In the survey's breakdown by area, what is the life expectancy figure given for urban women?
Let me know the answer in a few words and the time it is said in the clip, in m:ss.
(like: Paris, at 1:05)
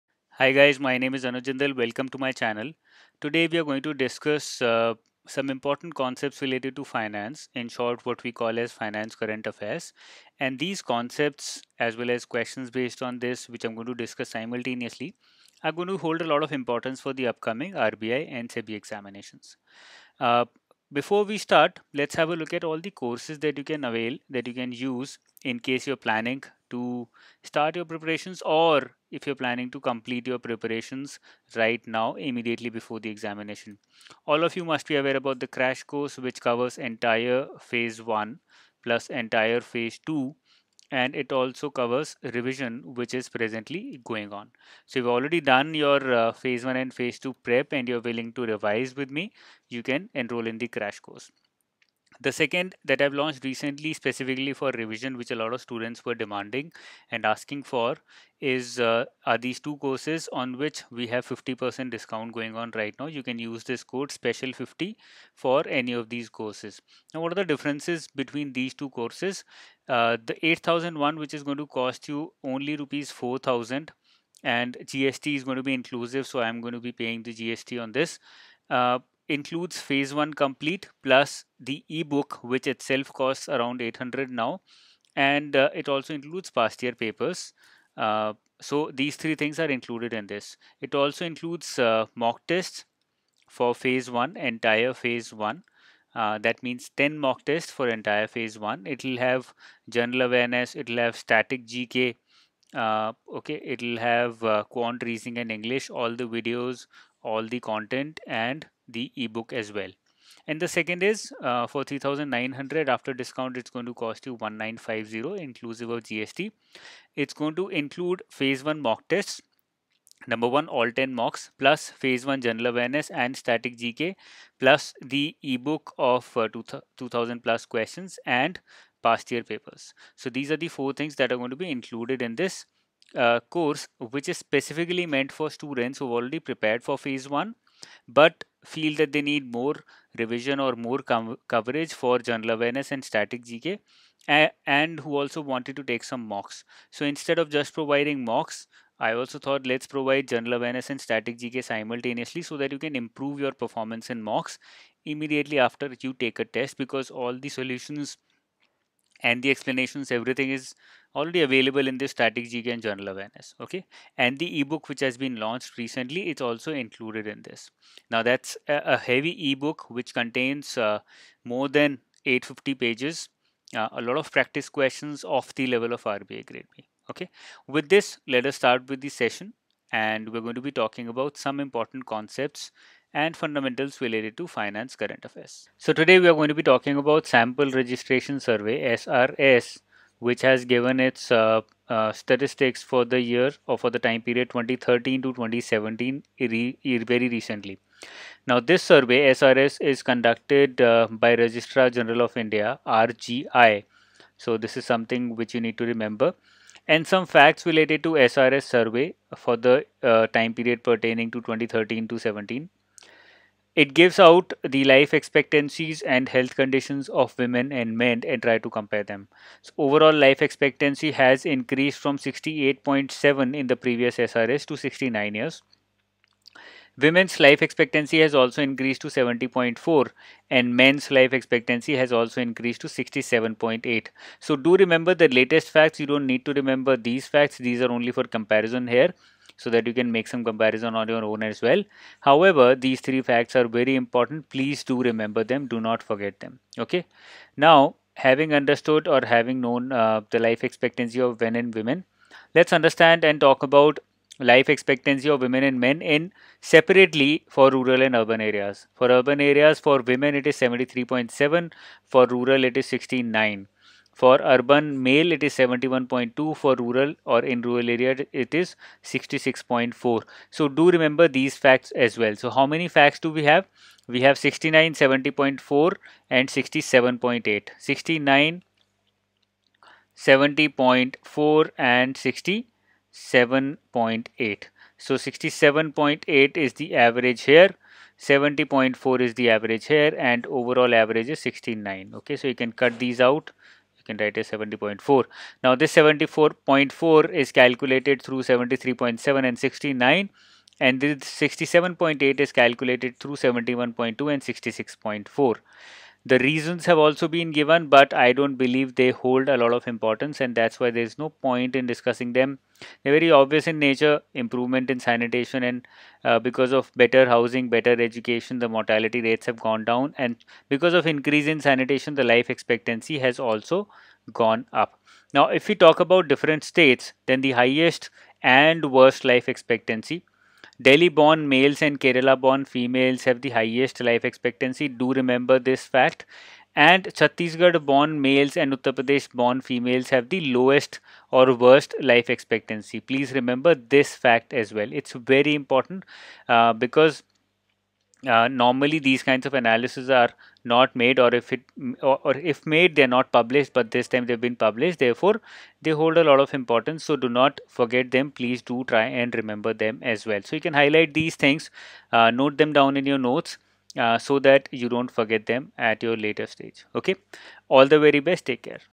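73.7, at 4:20.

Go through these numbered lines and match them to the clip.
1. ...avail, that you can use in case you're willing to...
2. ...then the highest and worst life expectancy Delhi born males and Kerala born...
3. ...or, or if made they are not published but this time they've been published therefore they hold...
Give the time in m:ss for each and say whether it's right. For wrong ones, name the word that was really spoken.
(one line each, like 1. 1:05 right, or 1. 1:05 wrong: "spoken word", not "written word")
1. 0:23 wrong: "planning", not "willing"
2. 5:27 right
3. 5:52 right.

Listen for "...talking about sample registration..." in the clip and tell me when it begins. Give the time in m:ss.
3:06.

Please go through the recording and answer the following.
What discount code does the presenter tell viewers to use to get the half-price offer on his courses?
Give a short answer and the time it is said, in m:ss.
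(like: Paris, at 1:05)
SPECIAL50, at 1:04.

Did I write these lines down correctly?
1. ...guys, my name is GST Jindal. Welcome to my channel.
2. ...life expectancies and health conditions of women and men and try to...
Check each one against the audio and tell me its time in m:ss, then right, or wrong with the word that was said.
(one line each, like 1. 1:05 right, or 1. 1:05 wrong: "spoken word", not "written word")
1. 0:00 wrong: "Anuj", not "GST"
2. 3:34 right.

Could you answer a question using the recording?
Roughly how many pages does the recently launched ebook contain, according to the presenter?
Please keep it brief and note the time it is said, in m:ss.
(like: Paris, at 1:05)
850, at 2:52.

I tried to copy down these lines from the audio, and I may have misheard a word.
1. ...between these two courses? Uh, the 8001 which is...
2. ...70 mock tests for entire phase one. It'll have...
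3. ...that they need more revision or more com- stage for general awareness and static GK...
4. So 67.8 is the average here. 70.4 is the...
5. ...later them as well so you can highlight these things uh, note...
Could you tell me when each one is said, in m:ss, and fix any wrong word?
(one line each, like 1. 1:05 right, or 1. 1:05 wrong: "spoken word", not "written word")
1. 1:08 right
2. 1:36 wrong: "10", not "70"
3. 2:18 wrong: "coverage", not "stage"
4. 4:44 right
5. 5:59 wrong: "remember", not "later".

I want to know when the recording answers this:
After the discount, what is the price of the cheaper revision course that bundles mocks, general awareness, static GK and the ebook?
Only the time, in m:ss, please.
1:54.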